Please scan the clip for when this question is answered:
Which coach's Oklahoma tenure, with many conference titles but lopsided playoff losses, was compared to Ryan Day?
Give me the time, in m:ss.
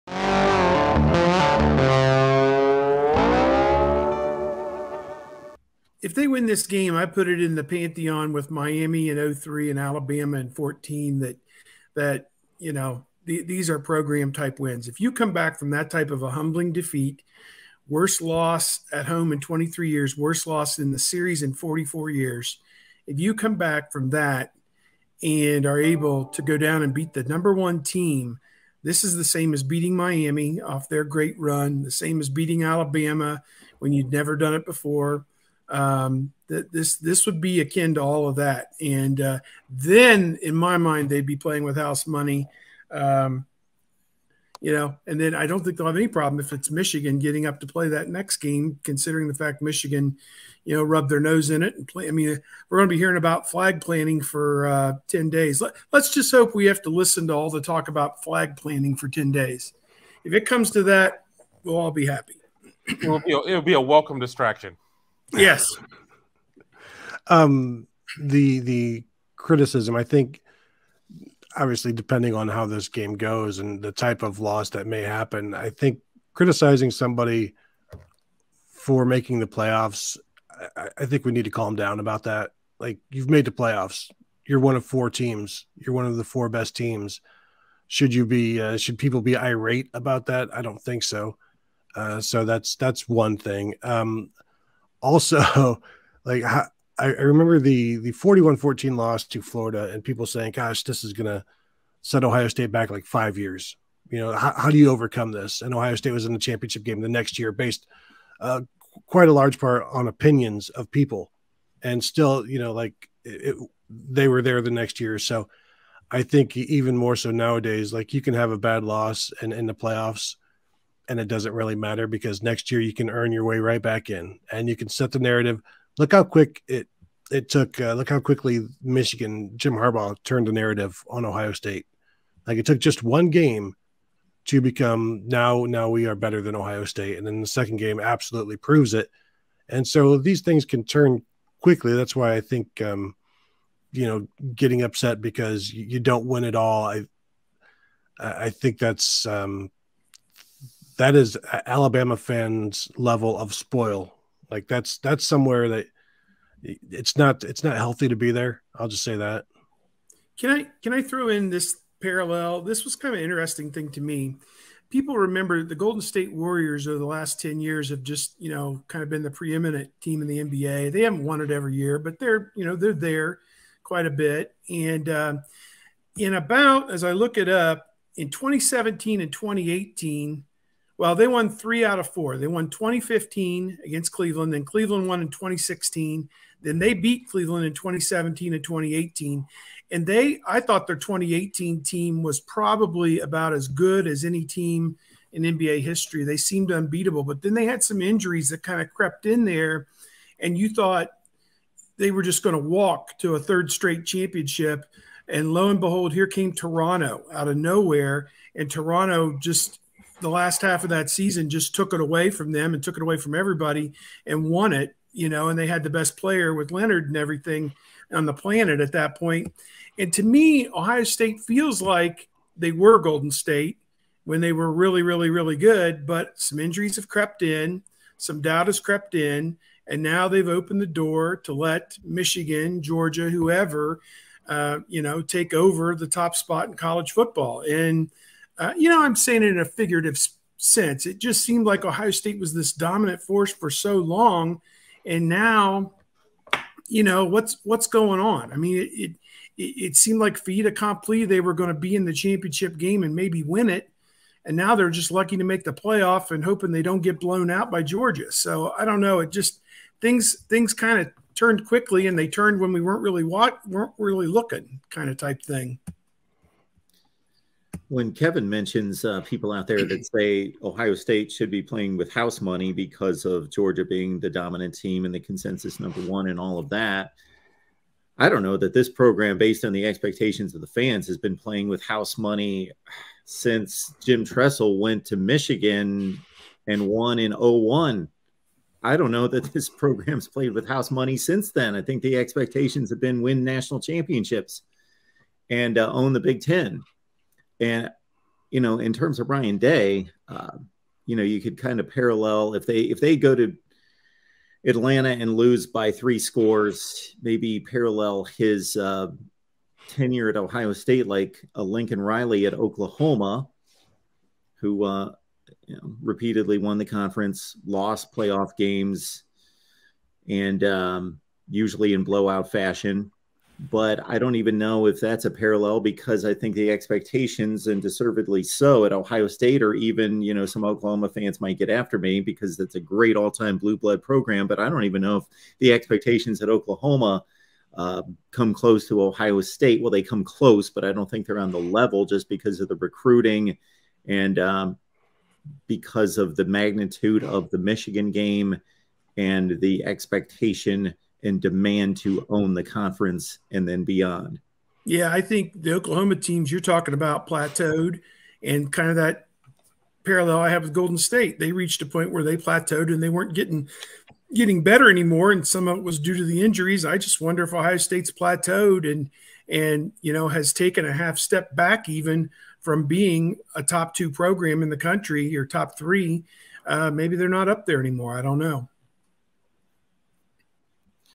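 5:11.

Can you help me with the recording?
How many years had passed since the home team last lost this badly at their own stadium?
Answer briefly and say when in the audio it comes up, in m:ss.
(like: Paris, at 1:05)
23, at 0:19.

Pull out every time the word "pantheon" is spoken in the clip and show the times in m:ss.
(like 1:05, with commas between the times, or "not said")
0:07.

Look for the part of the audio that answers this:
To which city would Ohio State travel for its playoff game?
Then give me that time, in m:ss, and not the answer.
5:04.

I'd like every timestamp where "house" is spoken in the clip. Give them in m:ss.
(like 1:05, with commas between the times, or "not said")
0:41, 4:32, 4:41, 4:50.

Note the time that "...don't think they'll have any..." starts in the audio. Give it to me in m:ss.
0:45.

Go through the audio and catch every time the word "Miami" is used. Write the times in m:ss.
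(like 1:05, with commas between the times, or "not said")
0:08, 0:29.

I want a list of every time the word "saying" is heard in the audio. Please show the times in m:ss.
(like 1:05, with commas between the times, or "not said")
1:40, 3:59.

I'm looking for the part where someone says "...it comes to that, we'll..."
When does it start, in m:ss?
1:00.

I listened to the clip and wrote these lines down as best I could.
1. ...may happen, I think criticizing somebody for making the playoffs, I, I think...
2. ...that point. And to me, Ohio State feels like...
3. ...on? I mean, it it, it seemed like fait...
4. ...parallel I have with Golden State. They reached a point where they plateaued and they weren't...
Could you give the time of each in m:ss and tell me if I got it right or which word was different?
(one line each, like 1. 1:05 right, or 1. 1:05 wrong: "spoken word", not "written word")
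1. 1:14 right
2. 3:38 right
3. 4:08 right
4. 6:00 right.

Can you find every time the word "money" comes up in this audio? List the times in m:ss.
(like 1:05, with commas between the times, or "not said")
0:42, 4:32, 4:42, 4:50.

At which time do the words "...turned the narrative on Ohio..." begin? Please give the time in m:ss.
2:10.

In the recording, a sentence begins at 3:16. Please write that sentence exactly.
They seemed unbeatable, but then they had some injuries that kind of crept in there.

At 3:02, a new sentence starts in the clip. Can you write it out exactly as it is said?
They won 2015 against Cleveland, then Cleveland won in 2016.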